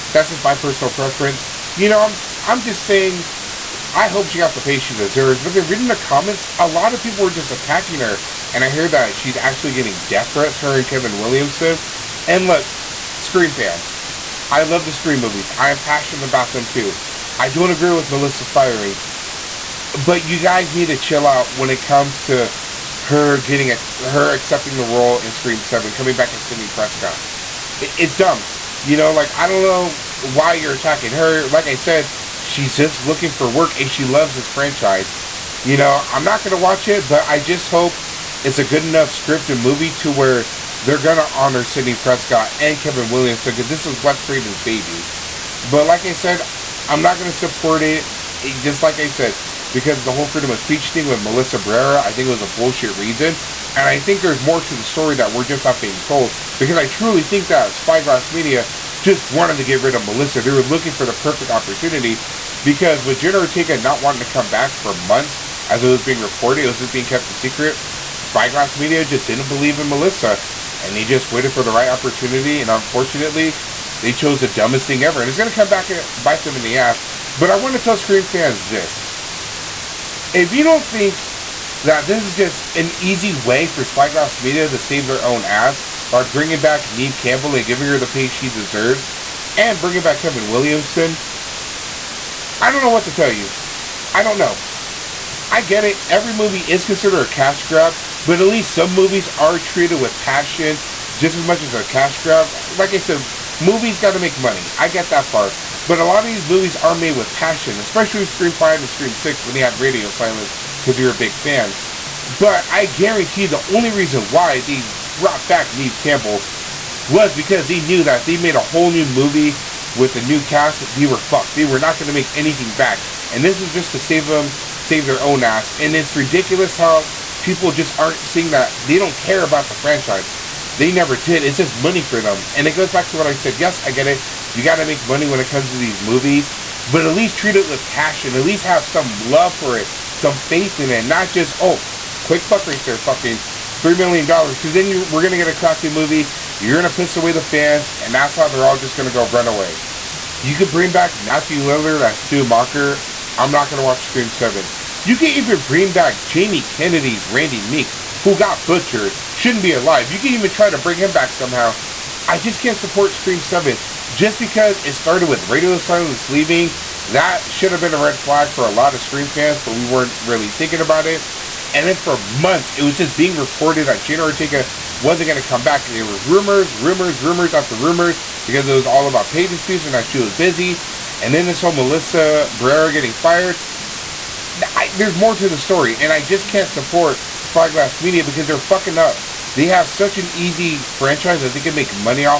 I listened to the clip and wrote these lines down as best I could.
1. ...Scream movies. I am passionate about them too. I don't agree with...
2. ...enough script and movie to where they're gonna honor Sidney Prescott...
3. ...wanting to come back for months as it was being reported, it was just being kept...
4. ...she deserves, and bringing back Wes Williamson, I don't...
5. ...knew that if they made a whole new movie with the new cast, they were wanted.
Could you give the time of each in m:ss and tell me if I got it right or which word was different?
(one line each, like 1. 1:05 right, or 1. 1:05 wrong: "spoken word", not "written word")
1. 0:14 right
2. 0:38 right
3. 1:04 right
4. 1:28 wrong: "Kevin", not "Wes"
5. 1:57 wrong: "fucked", not "wanted".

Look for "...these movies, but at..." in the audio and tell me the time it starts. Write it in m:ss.
2:15.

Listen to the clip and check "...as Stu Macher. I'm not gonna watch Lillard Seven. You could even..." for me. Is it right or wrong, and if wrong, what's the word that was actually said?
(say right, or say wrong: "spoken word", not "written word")
wrong: "Scream", not "Lillard".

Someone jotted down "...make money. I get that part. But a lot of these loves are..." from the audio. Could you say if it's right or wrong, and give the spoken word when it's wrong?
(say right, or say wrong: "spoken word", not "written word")
wrong: "movies", not "loves".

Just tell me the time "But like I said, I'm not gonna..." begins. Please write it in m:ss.
0:45.